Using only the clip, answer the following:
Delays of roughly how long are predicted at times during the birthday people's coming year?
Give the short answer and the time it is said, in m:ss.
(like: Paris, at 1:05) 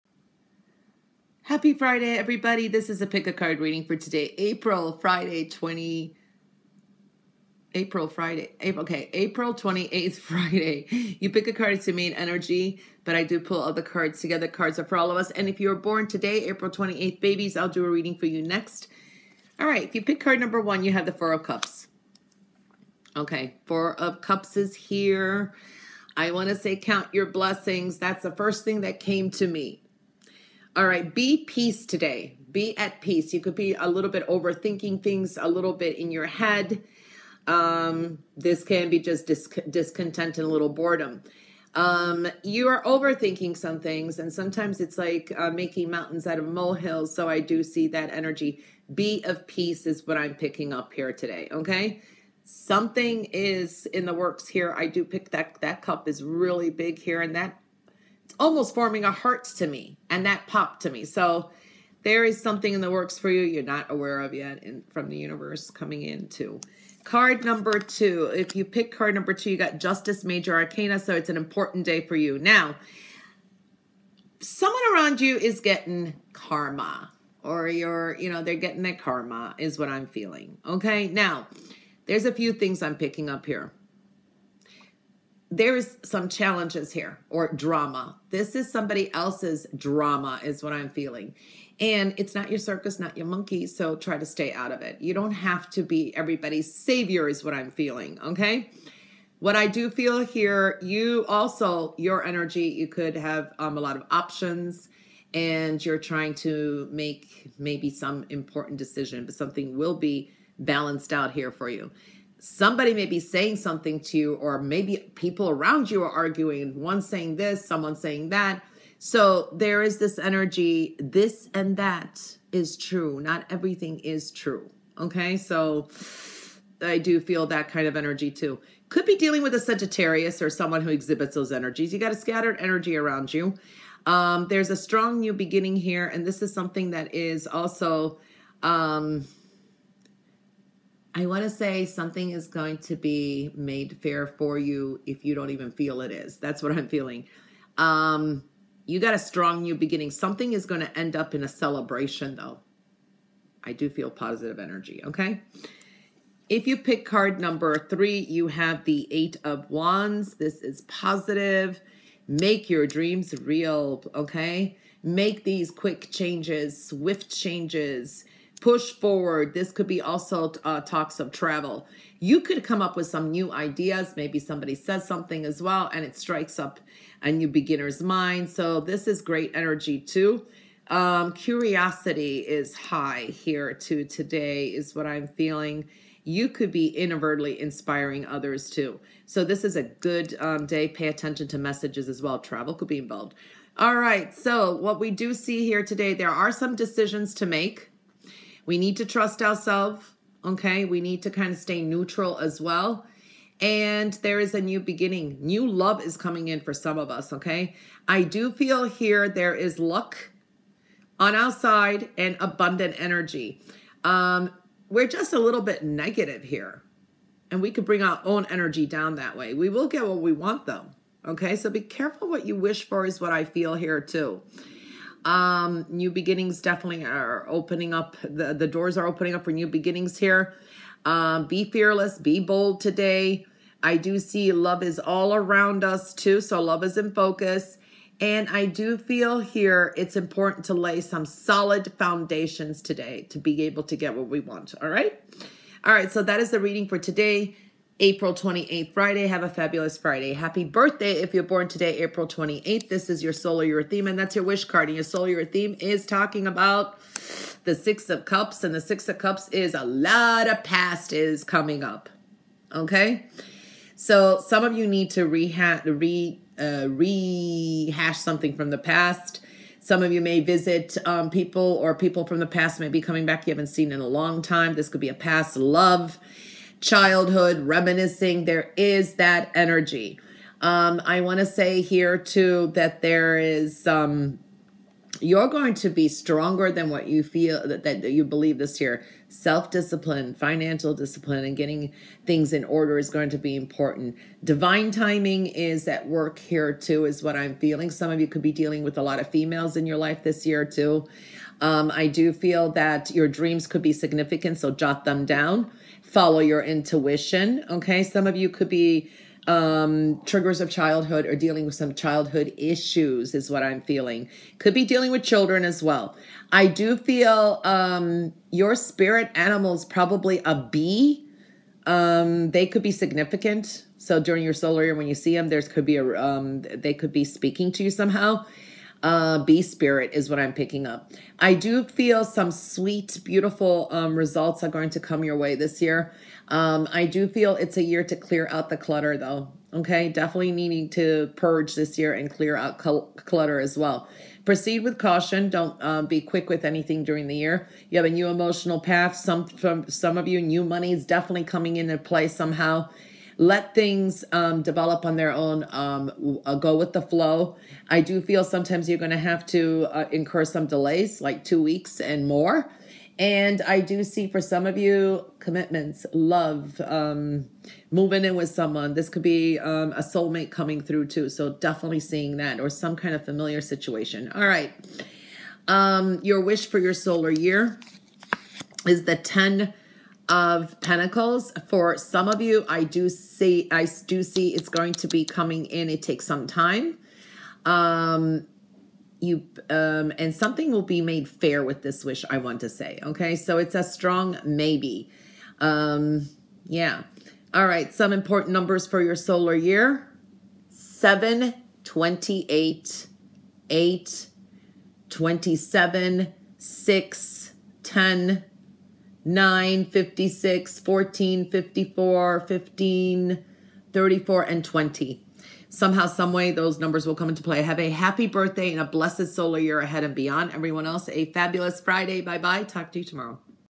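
2 weeks, at 6:01.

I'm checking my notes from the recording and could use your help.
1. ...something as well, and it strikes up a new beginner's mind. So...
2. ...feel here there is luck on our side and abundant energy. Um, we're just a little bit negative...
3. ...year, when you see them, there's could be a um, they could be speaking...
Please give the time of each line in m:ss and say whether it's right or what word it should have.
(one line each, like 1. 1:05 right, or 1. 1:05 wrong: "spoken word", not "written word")
1. 2:55 right
2. 3:28 right
3. 5:24 right.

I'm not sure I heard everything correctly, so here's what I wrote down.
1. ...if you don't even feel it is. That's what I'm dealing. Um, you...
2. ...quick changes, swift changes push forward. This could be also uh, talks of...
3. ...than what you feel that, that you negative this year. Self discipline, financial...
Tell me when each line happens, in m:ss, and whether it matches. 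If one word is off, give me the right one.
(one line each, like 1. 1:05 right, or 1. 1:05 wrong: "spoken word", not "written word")
1. 2:25 wrong: "feeling", not "dealing"
2. 2:45 right
3. 4:46 wrong: "believe", not "negative".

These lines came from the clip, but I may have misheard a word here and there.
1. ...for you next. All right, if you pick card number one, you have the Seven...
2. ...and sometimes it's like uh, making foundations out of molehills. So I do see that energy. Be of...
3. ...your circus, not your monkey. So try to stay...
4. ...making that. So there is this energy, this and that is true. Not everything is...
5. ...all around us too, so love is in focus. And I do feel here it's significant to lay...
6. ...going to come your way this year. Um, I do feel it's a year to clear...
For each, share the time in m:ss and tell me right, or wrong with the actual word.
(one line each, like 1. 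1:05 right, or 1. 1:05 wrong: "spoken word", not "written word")
1. 0:18 wrong: "Four", not "Seven"
2. 0:44 wrong: "mountains", not "foundations"
3. 1:32 right
4. 1:57 wrong: "saying", not "making"
5. 3:54 wrong: "important", not "significant"
6. 5:34 right.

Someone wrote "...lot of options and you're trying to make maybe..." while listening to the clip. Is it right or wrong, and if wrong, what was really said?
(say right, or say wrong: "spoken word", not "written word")
right.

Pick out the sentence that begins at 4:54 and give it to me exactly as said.
Divine timing is at work here too, is what I'm feeling.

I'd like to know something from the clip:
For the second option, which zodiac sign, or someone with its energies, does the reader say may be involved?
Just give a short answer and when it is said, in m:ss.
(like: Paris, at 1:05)
Sagittarius, at 2:09.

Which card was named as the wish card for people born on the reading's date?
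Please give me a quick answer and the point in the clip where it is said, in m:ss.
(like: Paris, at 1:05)
10 of Pentacles, at 6:19.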